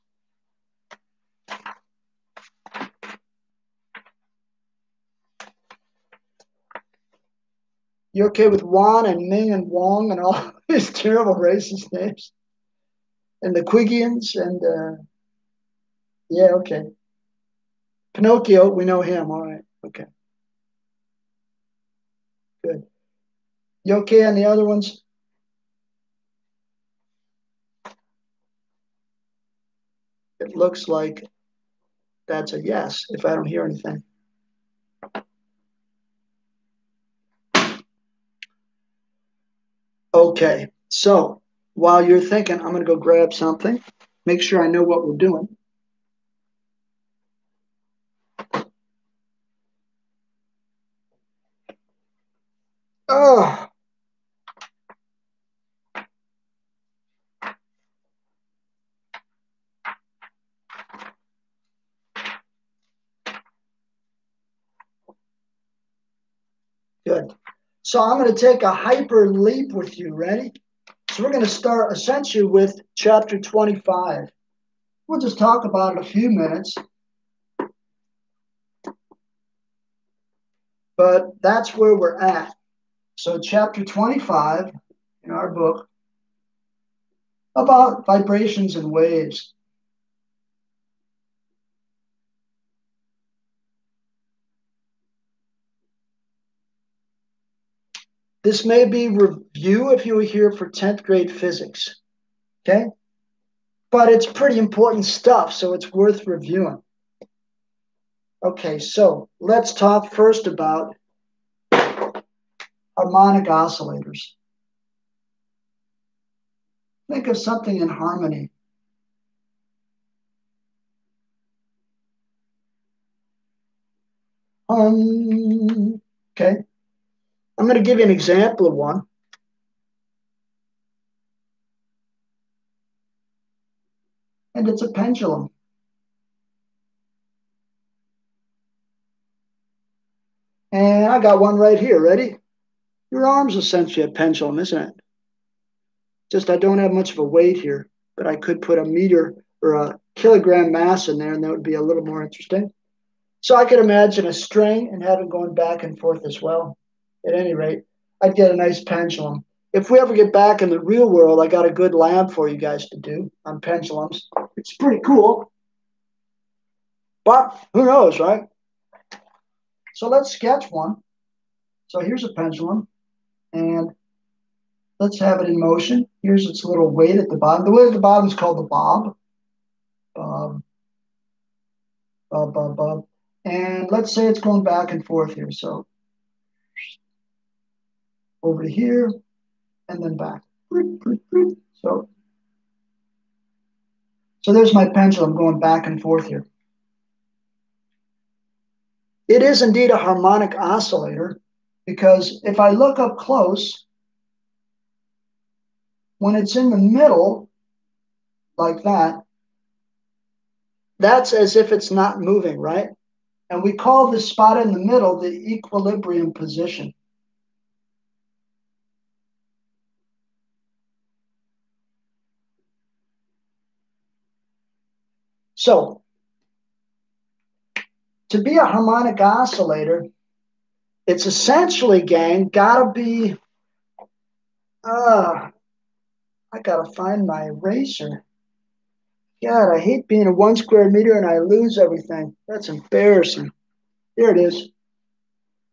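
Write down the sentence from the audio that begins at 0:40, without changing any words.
Okay, so while you're thinking, I'm going to go grab something, make sure I know what we're doing.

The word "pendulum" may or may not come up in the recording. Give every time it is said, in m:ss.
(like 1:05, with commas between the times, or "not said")
2:14, 2:24, 2:38, 2:43, 2:52.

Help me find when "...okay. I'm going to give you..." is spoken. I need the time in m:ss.
2:06.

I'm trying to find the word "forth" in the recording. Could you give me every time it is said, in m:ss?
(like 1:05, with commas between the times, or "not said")
2:35, 3:05, 3:15.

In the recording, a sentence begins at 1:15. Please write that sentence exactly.
We'll just talk about it a few minutes.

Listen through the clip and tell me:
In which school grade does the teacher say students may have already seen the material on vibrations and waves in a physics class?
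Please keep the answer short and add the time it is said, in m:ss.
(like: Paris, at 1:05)
10th grade, at 1:40.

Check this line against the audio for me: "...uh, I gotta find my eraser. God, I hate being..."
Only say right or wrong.
right.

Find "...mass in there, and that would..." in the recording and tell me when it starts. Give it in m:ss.
2:30.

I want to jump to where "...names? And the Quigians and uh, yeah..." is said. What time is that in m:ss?
0:11.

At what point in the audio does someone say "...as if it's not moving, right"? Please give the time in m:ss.
3:31.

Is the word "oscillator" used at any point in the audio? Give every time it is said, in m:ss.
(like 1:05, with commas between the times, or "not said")
1:53, 3:20, 3:49.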